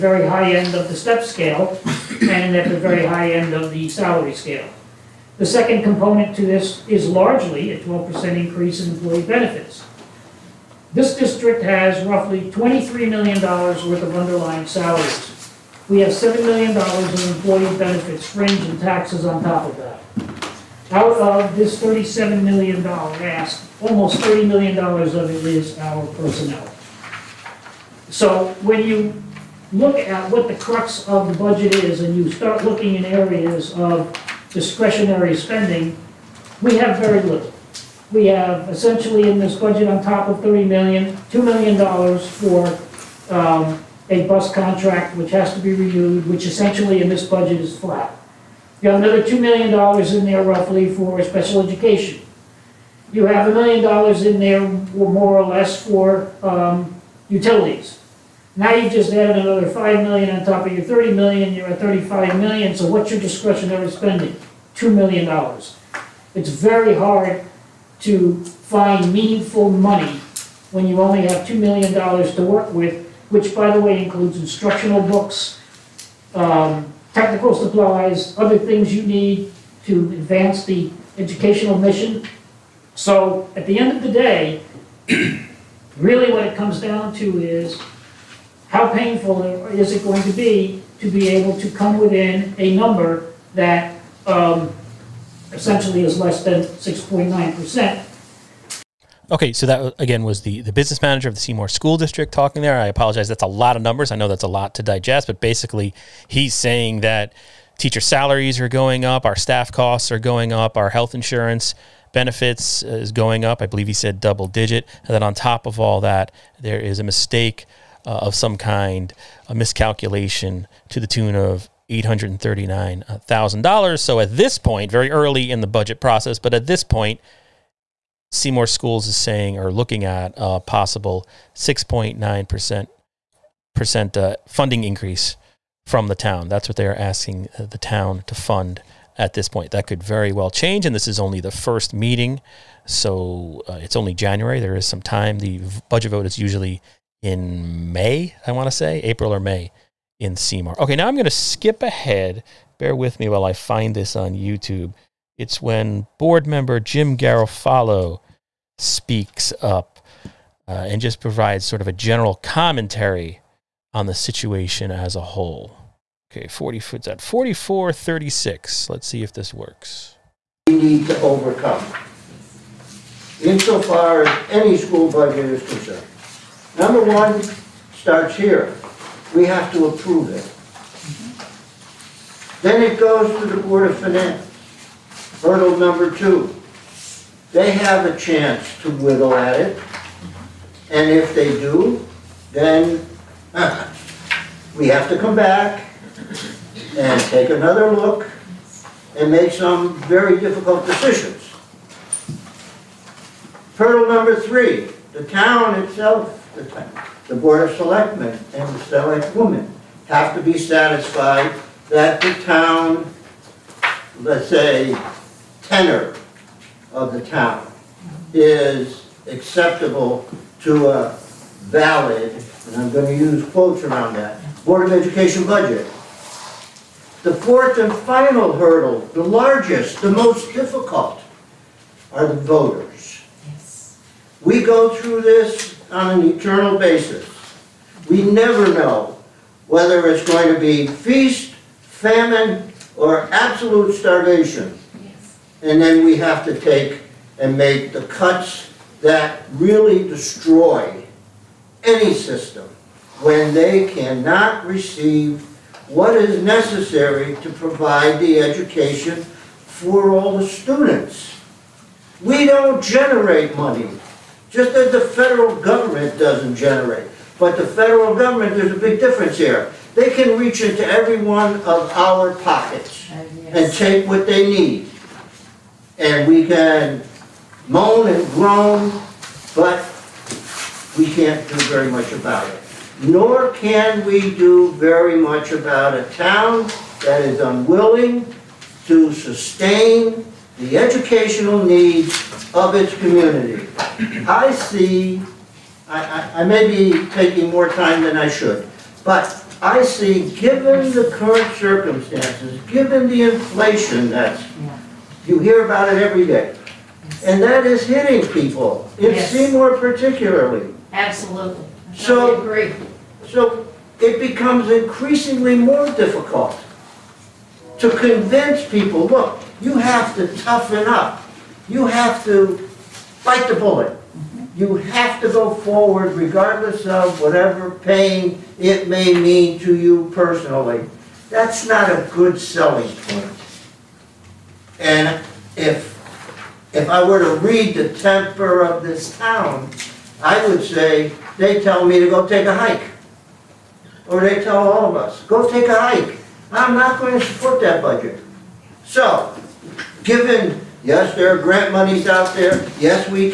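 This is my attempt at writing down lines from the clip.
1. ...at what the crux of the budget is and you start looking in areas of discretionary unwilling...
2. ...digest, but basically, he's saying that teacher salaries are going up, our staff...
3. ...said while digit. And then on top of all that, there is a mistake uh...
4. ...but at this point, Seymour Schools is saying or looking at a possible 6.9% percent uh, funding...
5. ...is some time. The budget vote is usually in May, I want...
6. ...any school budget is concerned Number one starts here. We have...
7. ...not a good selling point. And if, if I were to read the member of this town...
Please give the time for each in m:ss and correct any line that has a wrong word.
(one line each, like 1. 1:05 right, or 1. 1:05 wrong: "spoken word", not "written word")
1. 0:29 wrong: "spending", not "unwilling"
2. 1:44 right
3. 1:53 wrong: "double", not "while"
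4. 2:06 right
5. 2:24 right
6. 2:54 right
7. 5:31 wrong: "temper", not "member".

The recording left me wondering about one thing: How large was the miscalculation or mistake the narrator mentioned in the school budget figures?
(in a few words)
$839,000.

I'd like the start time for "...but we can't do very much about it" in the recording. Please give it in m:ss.
4:39.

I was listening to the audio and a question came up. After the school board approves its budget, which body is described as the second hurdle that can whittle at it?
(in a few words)
Board of Finance.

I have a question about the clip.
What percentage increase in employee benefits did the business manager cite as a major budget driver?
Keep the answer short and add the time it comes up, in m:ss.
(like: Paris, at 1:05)
12%, at 0:07.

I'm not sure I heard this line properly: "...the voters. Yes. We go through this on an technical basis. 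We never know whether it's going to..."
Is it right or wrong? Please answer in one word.
wrong.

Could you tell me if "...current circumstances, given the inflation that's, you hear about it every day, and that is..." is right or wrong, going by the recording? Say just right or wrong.
right.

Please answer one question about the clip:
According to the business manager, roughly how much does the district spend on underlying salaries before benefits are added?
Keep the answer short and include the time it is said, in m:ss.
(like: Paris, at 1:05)
$23 million, at 0:12.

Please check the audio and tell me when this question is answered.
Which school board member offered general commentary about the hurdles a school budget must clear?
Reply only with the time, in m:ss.
2:36.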